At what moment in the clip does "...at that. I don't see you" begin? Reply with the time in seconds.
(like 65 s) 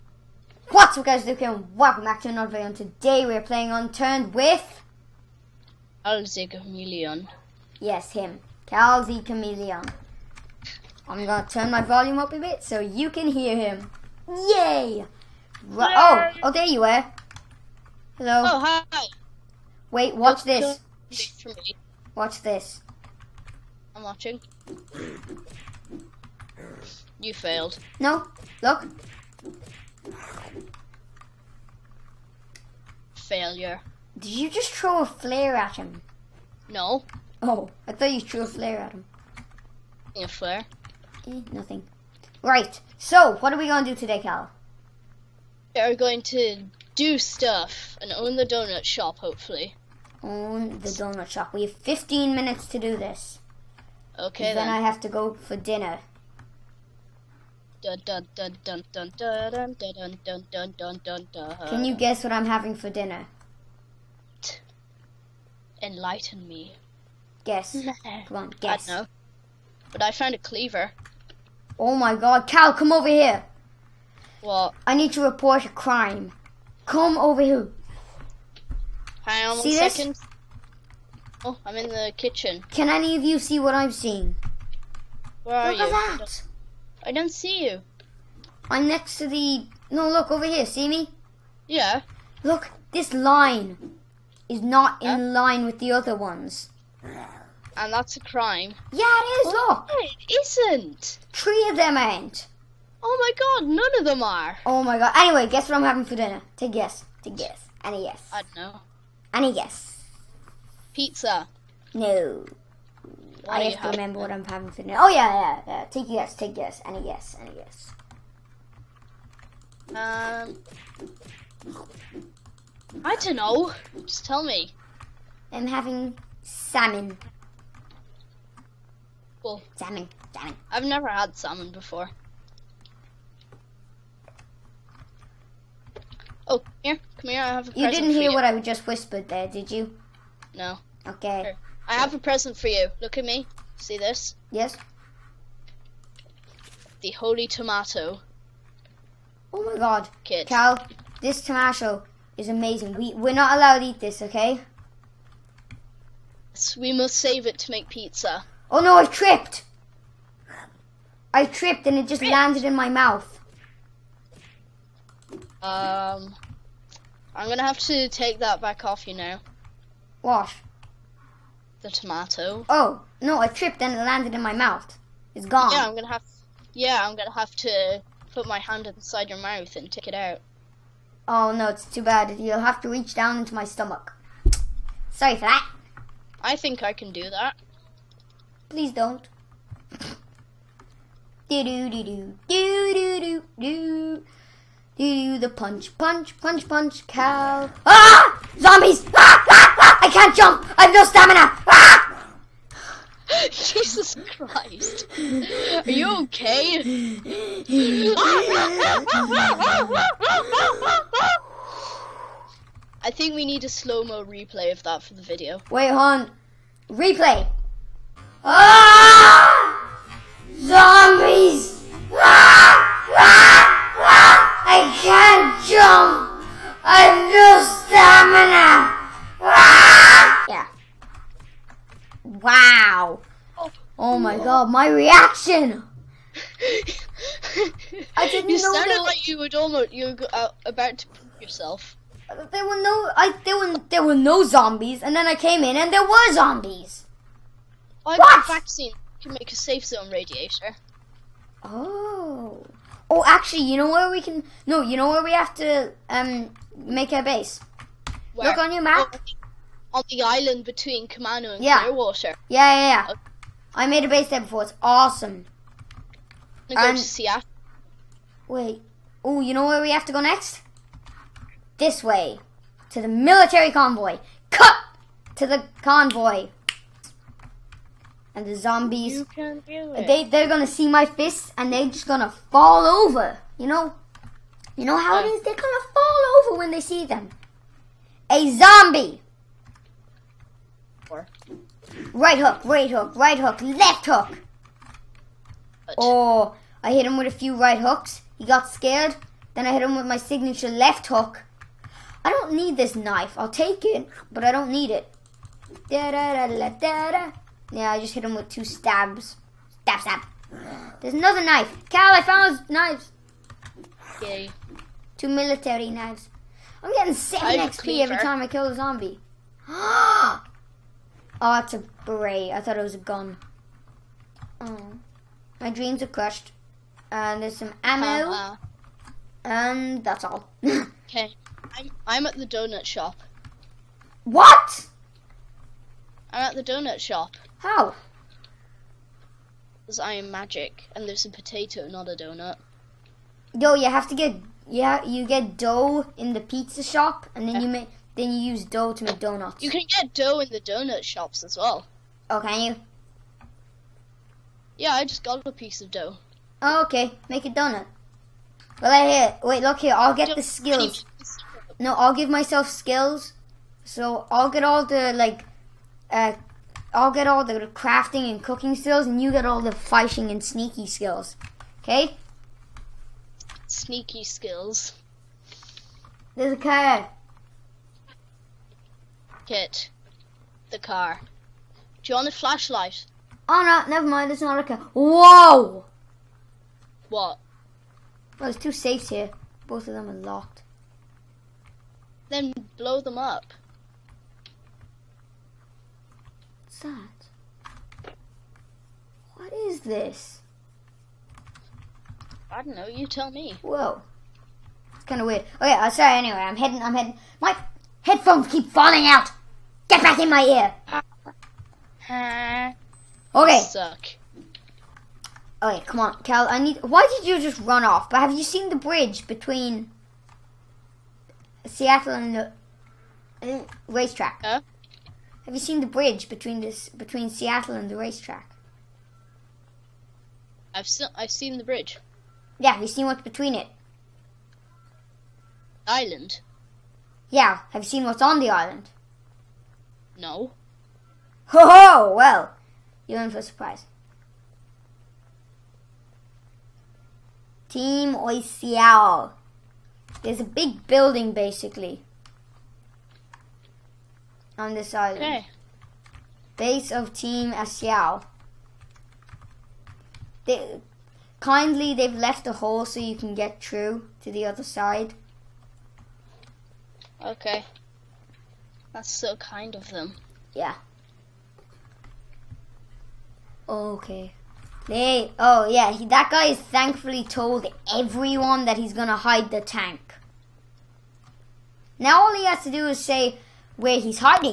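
86 s.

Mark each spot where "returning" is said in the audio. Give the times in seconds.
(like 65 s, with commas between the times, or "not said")
not said.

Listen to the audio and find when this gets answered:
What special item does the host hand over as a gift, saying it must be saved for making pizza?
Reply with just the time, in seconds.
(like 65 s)
147 s.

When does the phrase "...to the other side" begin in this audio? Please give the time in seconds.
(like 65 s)
464 s.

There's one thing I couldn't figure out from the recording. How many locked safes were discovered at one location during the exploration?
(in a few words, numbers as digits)
2.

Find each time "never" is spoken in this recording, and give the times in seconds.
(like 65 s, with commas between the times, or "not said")
130 s, 383 s.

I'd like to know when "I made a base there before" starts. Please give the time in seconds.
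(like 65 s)
263 s.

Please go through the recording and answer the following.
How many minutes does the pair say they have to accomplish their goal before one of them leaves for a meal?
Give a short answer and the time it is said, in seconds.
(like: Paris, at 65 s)
15, at 51 s.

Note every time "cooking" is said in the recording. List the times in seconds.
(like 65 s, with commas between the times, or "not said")
368 s.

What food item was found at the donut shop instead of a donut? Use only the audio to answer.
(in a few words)
A potato.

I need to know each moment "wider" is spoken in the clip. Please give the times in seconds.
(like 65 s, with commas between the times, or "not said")
not said.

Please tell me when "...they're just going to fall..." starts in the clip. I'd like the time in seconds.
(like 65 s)
281 s.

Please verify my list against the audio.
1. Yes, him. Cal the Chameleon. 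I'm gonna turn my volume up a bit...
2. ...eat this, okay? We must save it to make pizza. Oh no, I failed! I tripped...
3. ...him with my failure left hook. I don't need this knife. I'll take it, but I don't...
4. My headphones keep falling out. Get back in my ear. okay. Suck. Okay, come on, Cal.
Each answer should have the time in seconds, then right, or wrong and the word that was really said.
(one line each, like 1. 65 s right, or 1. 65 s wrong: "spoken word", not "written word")
1. 7 s right
2. 153 s wrong: "tripped", not "failed"
3. 299 s wrong: "signature", not "failure"
4. 407 s right.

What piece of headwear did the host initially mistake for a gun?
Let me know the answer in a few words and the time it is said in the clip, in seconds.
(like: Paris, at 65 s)
A beret, at 322 s.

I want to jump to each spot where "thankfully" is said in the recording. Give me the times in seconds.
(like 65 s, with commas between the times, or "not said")
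476 s.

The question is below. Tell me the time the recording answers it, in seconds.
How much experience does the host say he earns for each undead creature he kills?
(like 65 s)
317 s.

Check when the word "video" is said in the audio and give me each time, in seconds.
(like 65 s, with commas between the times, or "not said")
2 s, 215 s.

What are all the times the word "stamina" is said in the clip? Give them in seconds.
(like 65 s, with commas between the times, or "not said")
201 s, 227 s.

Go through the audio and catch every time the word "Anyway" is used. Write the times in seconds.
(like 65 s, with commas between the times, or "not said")
105 s, 406 s.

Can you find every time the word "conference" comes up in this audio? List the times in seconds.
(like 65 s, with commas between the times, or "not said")
not said.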